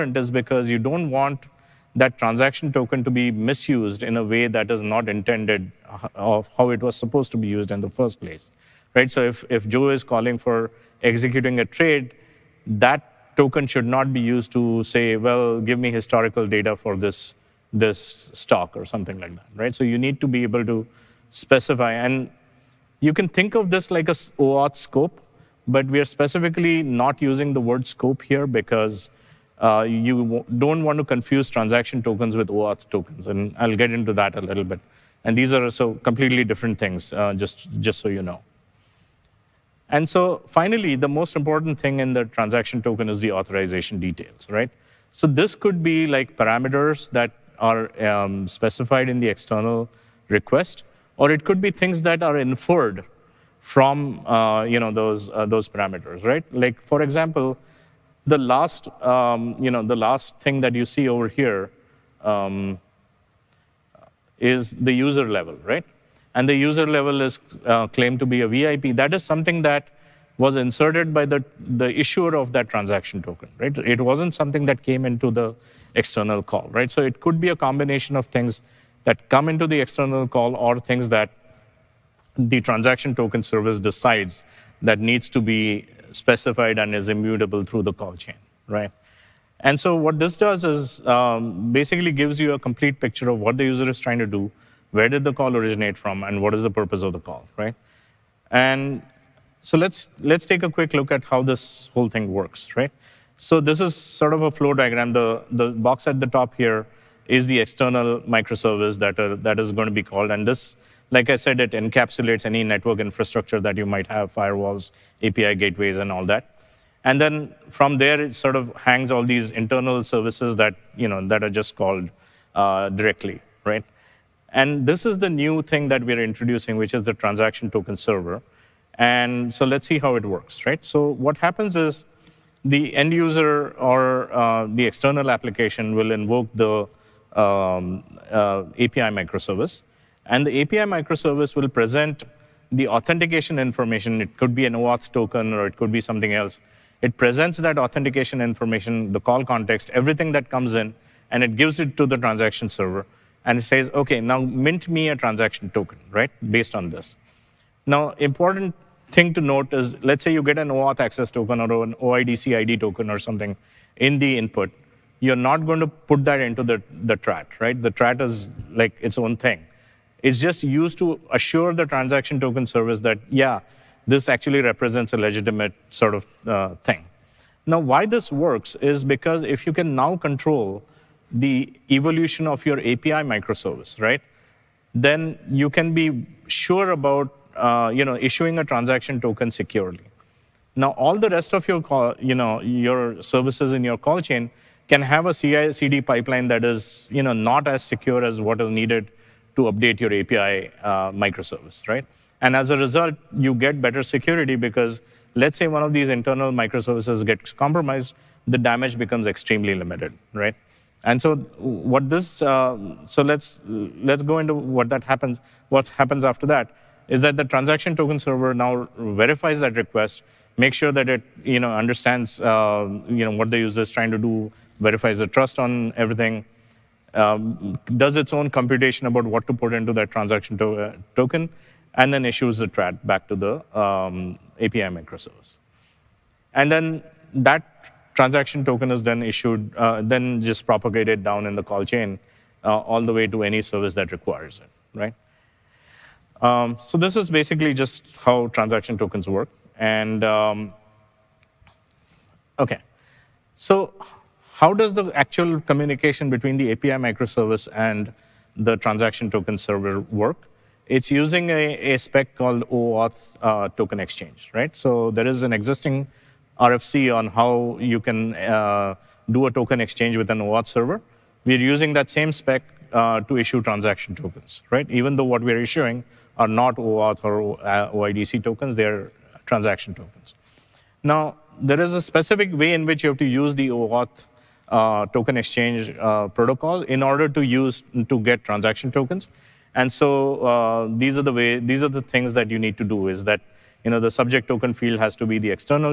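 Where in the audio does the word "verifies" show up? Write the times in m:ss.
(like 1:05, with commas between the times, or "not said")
3:39, 3:44.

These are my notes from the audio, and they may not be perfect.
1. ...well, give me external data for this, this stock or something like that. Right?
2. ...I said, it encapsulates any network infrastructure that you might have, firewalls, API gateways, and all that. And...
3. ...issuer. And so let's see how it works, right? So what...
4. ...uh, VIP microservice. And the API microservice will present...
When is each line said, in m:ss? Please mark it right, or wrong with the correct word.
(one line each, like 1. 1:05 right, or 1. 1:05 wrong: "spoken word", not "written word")
1. 0:15 wrong: "historical", not "external"
2. 1:51 right
3. 2:07 wrong: "server", not "issuer"
4. 2:18 wrong: "API", not "VIP".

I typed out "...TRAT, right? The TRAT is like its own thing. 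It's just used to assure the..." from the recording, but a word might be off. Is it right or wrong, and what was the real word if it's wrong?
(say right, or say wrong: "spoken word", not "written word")
right.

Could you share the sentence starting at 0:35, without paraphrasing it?
And these are so completely different things, uh, just, just so you know.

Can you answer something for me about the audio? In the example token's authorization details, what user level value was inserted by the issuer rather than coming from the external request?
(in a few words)
VIP.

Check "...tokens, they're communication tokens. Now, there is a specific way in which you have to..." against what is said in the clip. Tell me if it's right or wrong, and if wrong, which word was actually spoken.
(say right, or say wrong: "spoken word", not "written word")
wrong: "transaction", not "communication".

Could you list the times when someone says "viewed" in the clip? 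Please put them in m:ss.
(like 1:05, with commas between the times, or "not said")
not said.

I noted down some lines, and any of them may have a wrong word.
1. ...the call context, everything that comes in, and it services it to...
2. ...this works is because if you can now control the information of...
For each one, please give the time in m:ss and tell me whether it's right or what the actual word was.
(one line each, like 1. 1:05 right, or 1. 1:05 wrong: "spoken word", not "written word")
1. 2:29 wrong: "gives", not "services"
2. 2:58 wrong: "evolution", not "information".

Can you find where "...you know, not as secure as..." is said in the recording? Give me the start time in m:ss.
3:17.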